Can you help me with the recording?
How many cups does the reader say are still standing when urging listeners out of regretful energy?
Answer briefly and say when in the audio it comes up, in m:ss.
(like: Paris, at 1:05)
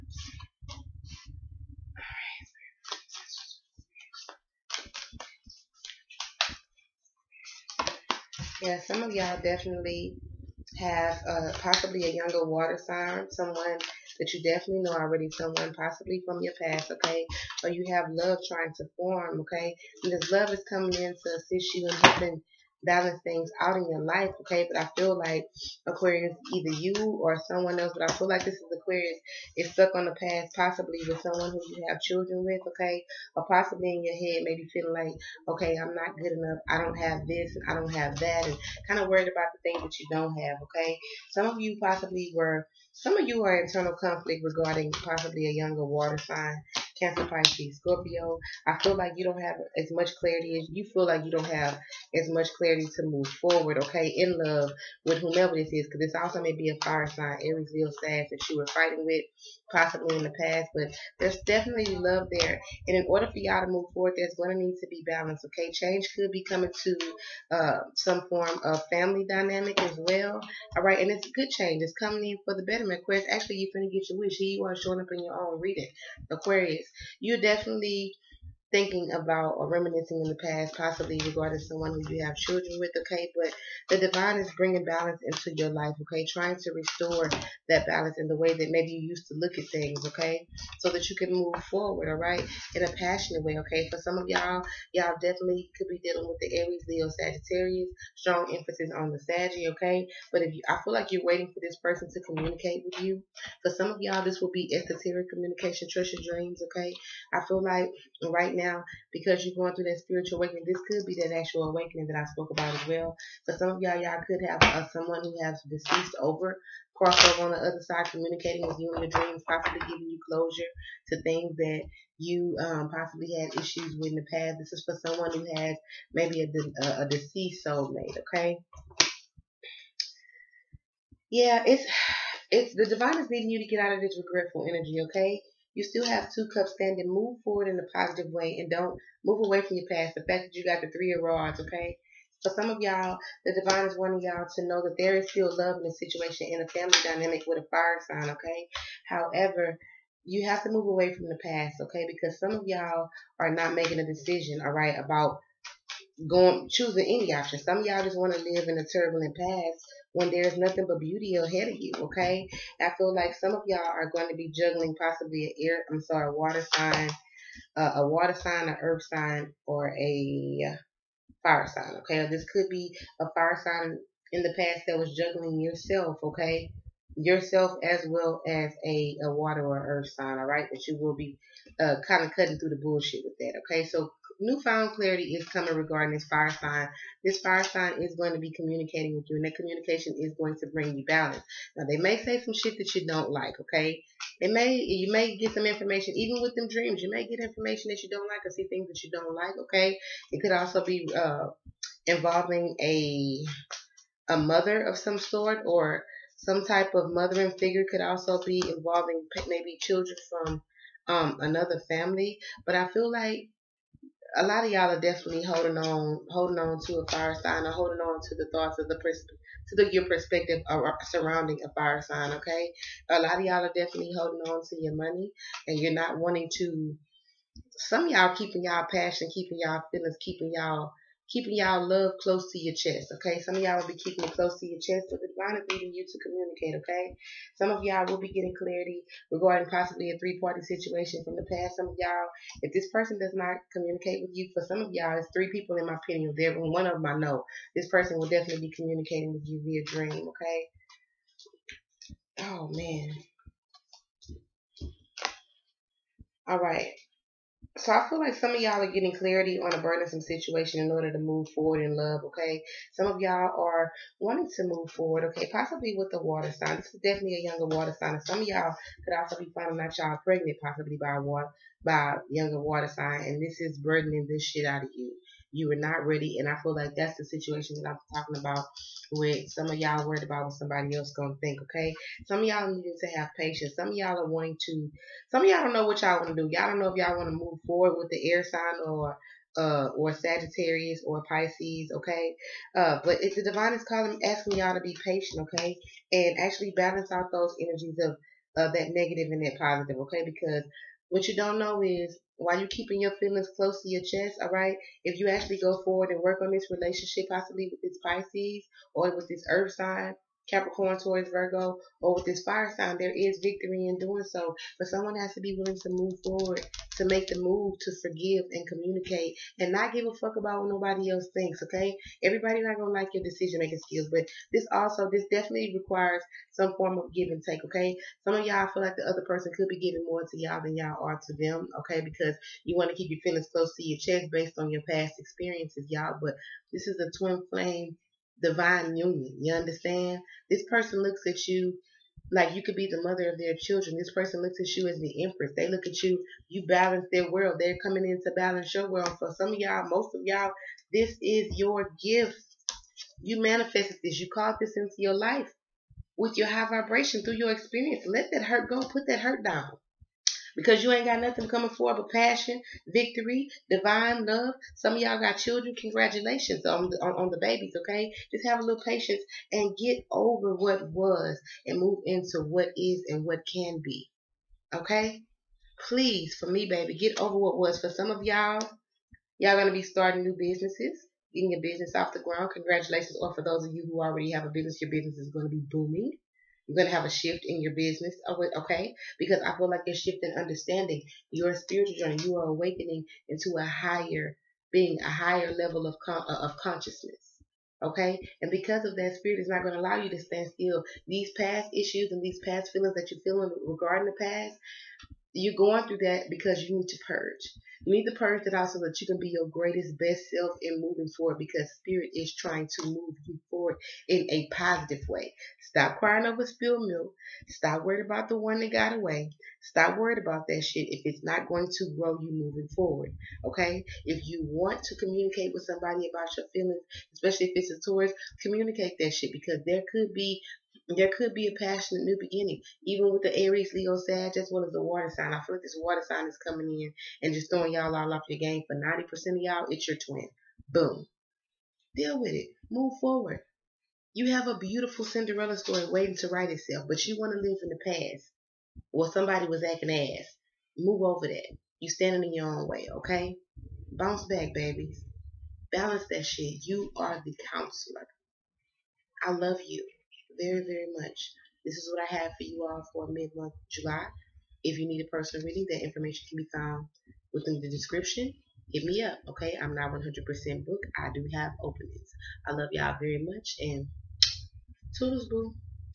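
2, at 2:16.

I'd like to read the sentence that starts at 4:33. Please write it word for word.
And this is burdening this shit out of you you were not ready.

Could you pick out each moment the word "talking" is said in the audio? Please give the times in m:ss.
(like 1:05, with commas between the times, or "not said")
4:38.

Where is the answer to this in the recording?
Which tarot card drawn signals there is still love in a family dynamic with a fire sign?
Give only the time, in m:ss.
2:20.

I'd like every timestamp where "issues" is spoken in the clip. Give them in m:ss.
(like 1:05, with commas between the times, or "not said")
2:03, 6:41.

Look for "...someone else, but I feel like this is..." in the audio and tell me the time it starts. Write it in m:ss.
0:27.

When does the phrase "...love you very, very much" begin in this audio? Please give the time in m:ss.
7:39.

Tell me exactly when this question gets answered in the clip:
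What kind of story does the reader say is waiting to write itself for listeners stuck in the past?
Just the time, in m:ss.
7:25.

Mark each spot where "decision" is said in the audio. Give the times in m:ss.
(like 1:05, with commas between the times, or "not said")
2:34, 5:23.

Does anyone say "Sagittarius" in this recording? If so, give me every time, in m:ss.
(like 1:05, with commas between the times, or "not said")
1:37, 4:50.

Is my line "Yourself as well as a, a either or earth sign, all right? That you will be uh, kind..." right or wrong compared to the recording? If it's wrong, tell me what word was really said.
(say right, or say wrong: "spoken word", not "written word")
wrong: "water", not "either".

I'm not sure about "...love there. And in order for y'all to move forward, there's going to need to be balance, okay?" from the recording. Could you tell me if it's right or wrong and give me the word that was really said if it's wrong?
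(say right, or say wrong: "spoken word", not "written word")
right.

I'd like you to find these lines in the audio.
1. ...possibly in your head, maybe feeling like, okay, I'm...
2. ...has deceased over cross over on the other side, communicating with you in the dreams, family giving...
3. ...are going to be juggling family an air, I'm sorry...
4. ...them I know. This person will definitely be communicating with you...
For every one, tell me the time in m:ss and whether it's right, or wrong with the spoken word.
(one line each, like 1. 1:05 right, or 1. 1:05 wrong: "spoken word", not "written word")
1. 0:33 right
2. 1:55 wrong: "possibly", not "family"
3. 2:43 wrong: "possibly", not "family"
4. 4:06 right.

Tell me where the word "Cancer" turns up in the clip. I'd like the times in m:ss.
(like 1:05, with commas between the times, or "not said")
0:46.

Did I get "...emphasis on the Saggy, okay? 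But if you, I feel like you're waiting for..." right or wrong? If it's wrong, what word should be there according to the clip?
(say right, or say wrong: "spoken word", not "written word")
right.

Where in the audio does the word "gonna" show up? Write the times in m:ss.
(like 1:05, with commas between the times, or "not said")
4:41, 5:22.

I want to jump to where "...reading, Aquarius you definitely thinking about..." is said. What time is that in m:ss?
1:15.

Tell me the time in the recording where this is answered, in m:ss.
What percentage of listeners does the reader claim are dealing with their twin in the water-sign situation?
7:18.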